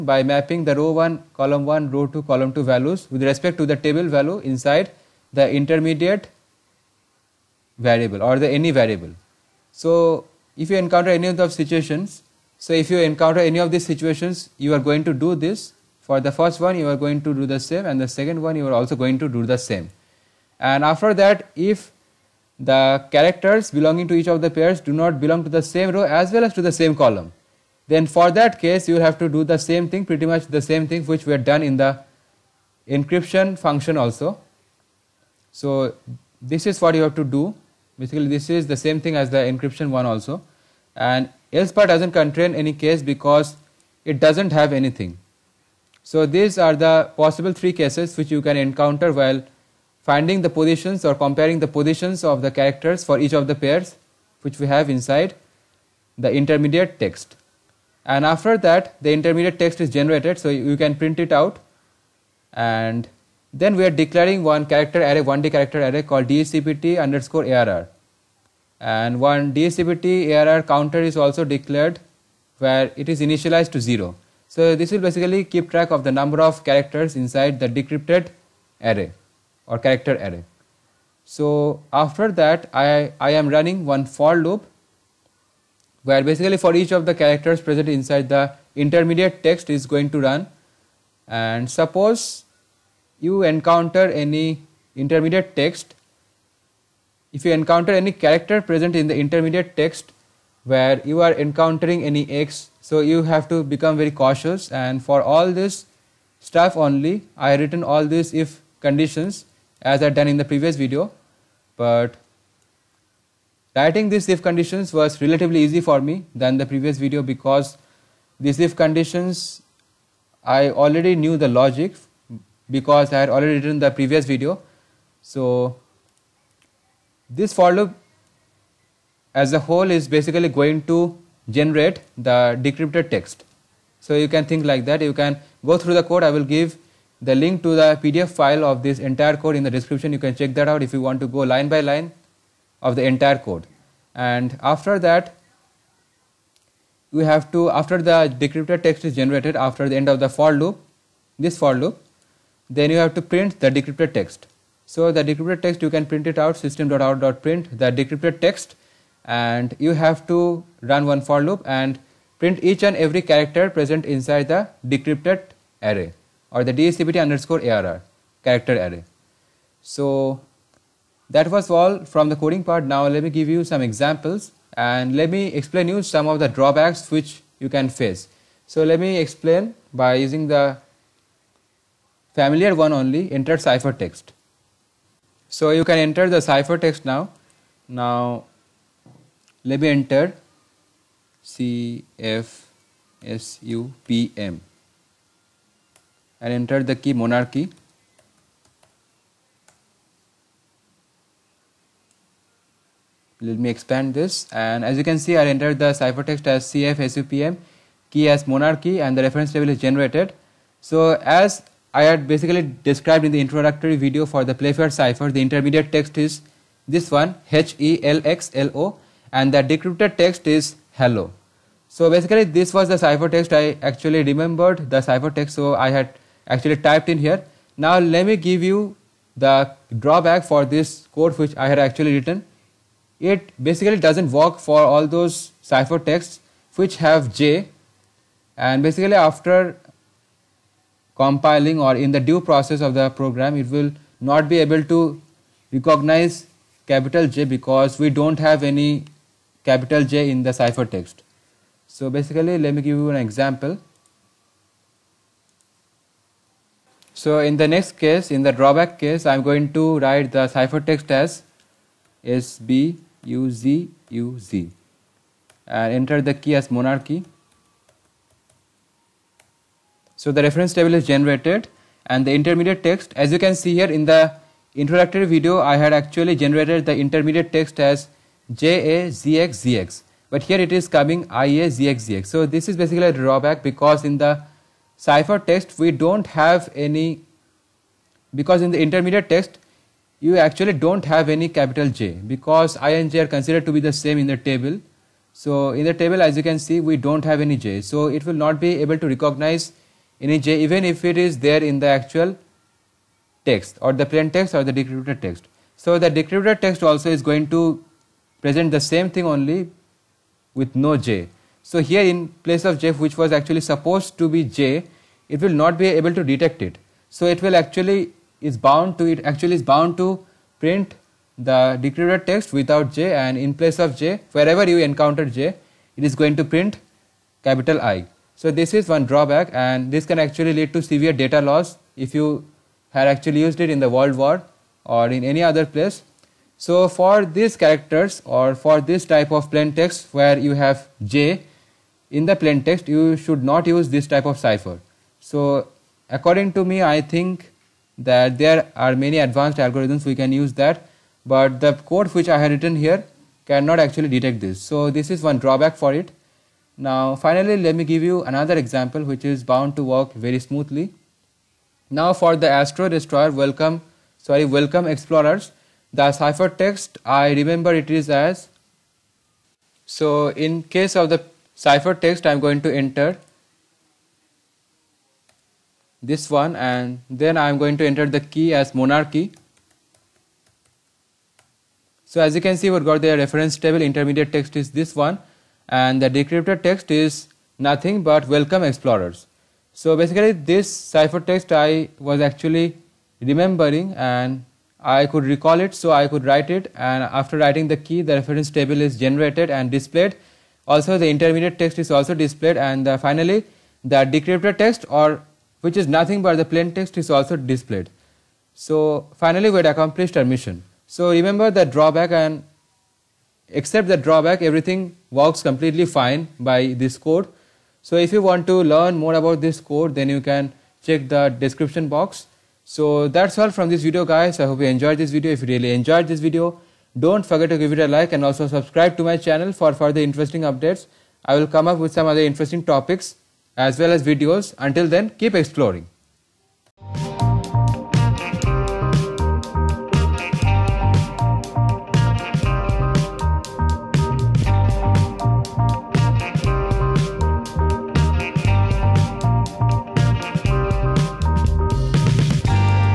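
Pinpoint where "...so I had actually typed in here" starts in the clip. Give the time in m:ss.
3:45.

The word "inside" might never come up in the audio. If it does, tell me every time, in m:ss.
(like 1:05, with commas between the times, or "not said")
0:04, 0:54, 1:17, 1:27, 2:44.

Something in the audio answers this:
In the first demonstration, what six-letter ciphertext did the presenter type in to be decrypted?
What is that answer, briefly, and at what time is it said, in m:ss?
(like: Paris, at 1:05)
CFSUPM, at 3:11.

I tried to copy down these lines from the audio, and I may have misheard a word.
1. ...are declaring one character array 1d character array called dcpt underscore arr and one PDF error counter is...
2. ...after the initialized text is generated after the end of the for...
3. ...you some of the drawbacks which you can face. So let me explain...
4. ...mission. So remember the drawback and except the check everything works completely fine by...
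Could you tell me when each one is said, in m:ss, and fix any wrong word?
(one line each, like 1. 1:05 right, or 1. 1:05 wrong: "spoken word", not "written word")
1. 1:03 wrong: "DSCPT", not "PDF"
2. 2:27 wrong: "decrypted", not "initialized"
3. 2:55 right
4. 6:50 wrong: "drawback", not "check".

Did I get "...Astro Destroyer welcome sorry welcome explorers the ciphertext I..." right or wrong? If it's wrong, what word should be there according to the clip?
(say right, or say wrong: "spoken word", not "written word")
right.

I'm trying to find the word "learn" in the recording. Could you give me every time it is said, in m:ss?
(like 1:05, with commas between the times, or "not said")
6:58.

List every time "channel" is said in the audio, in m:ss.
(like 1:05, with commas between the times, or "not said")
7:09.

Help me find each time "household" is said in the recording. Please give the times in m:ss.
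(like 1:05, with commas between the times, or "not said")
not said.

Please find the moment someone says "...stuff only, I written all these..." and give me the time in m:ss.
1:46.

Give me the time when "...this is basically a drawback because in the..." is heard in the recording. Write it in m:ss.
4:42.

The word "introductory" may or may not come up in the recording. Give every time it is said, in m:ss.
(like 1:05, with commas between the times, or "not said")
3:33, 4:34.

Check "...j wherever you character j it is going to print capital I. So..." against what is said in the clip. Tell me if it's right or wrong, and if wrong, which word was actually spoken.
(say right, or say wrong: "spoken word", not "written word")
wrong: "encounter", not "character".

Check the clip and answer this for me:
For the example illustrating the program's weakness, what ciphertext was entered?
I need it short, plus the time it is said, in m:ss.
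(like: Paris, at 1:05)
SBUZUZ, at 4:22.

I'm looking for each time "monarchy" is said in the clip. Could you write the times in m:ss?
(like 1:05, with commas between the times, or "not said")
3:17, 3:28, 4:26, 6:18.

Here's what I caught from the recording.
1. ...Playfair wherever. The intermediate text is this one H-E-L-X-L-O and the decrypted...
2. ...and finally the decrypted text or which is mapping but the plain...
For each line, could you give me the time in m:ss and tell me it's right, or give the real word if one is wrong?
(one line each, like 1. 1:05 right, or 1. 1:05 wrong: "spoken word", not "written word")
1. 3:34 wrong: "cipher", not "wherever"
2. 6:42 wrong: "nothing", not "mapping".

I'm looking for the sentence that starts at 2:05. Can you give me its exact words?
So this for loop as a whole is basically going to generate the decrypted text.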